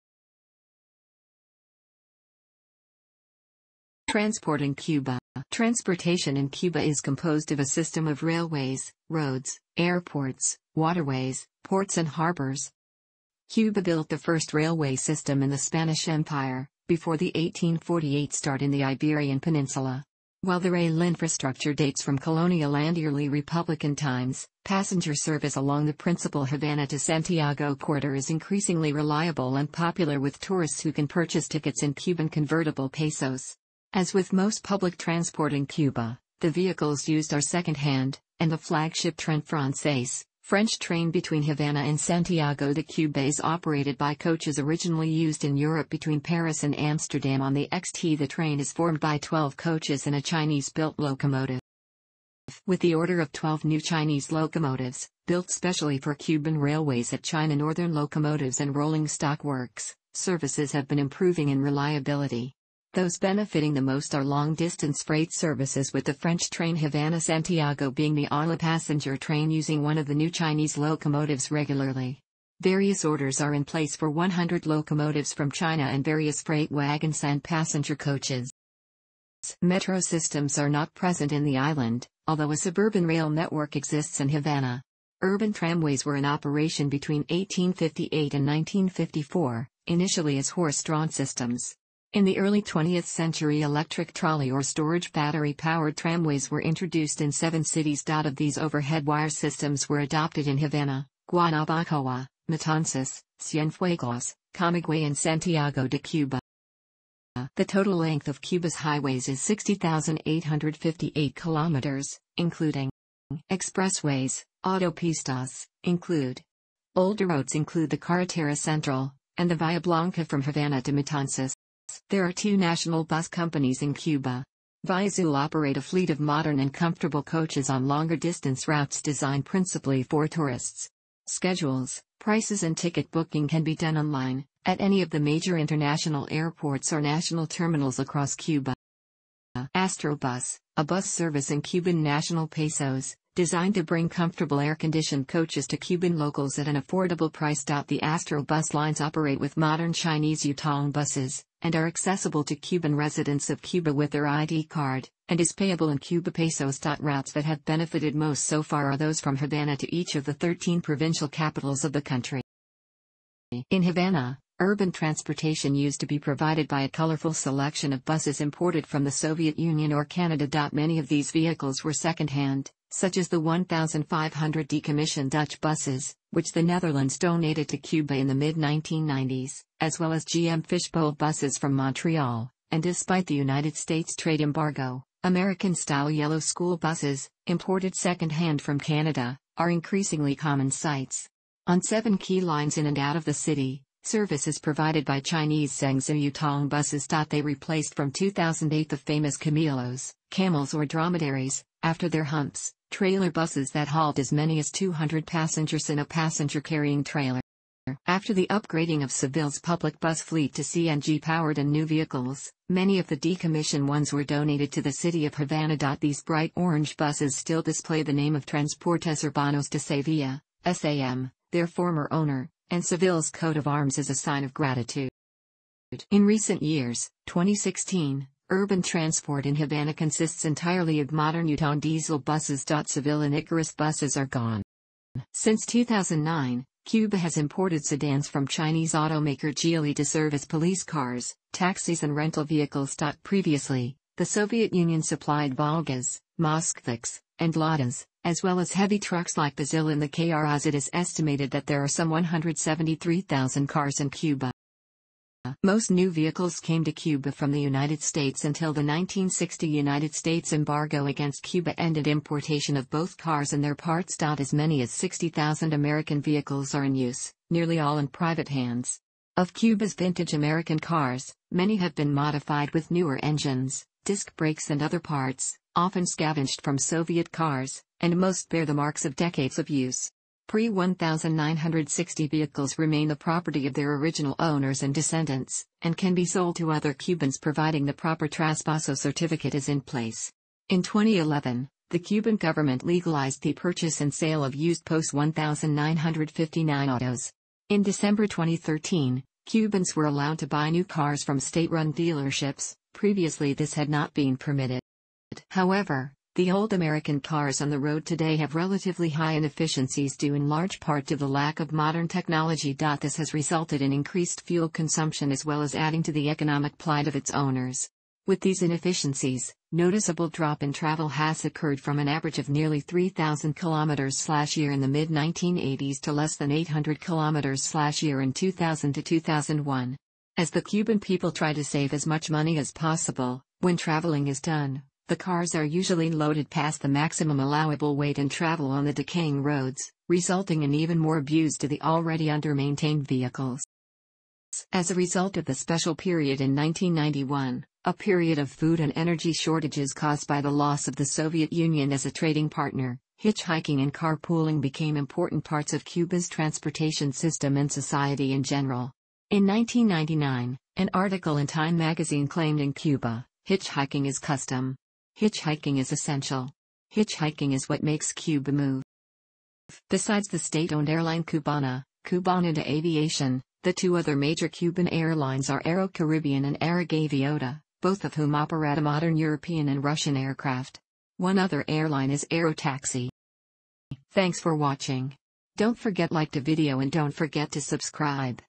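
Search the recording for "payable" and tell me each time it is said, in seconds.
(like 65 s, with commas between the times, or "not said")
155 s.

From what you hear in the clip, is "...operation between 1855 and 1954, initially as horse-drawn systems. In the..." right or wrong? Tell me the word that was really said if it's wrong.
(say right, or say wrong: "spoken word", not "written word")
wrong: "1858", not "1855".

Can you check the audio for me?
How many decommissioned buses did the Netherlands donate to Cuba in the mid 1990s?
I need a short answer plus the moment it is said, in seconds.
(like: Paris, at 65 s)
1,500, at 173 s.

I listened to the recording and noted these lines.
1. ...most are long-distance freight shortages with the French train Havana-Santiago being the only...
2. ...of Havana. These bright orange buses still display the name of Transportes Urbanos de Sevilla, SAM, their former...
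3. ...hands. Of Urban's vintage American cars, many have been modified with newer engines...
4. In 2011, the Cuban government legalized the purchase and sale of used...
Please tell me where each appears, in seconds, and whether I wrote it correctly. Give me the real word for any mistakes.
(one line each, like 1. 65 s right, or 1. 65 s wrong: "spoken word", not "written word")
1. 63 s wrong: "services", not "shortages"
2. 215 s right
3. 268 s wrong: "Cuba", not "Urban"
4. 290 s right.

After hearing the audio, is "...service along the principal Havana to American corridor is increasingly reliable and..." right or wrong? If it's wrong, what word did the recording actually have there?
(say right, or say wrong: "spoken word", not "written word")
wrong: "Santiago", not "American".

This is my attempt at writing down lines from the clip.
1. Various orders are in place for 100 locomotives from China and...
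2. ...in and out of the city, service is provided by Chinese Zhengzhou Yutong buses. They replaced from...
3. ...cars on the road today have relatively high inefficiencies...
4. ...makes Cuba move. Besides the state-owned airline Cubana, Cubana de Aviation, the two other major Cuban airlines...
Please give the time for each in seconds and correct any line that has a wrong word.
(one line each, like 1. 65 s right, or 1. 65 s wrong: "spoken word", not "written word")
1. 72 s right
2. 192 s right
3. 307 s right
4. 367 s right.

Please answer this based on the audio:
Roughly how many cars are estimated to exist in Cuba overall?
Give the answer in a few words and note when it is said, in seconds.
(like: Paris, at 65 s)
173,000, at 252 s.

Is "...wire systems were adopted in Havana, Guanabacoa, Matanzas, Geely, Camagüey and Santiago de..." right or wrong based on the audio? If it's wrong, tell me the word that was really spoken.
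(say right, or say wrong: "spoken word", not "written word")
wrong: "Cienfuegos", not "Geely".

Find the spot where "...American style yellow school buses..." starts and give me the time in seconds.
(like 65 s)
185 s.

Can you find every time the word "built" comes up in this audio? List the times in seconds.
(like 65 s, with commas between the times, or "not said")
13 s, 50 s, 55 s.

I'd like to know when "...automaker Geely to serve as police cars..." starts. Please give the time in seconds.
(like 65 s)
238 s.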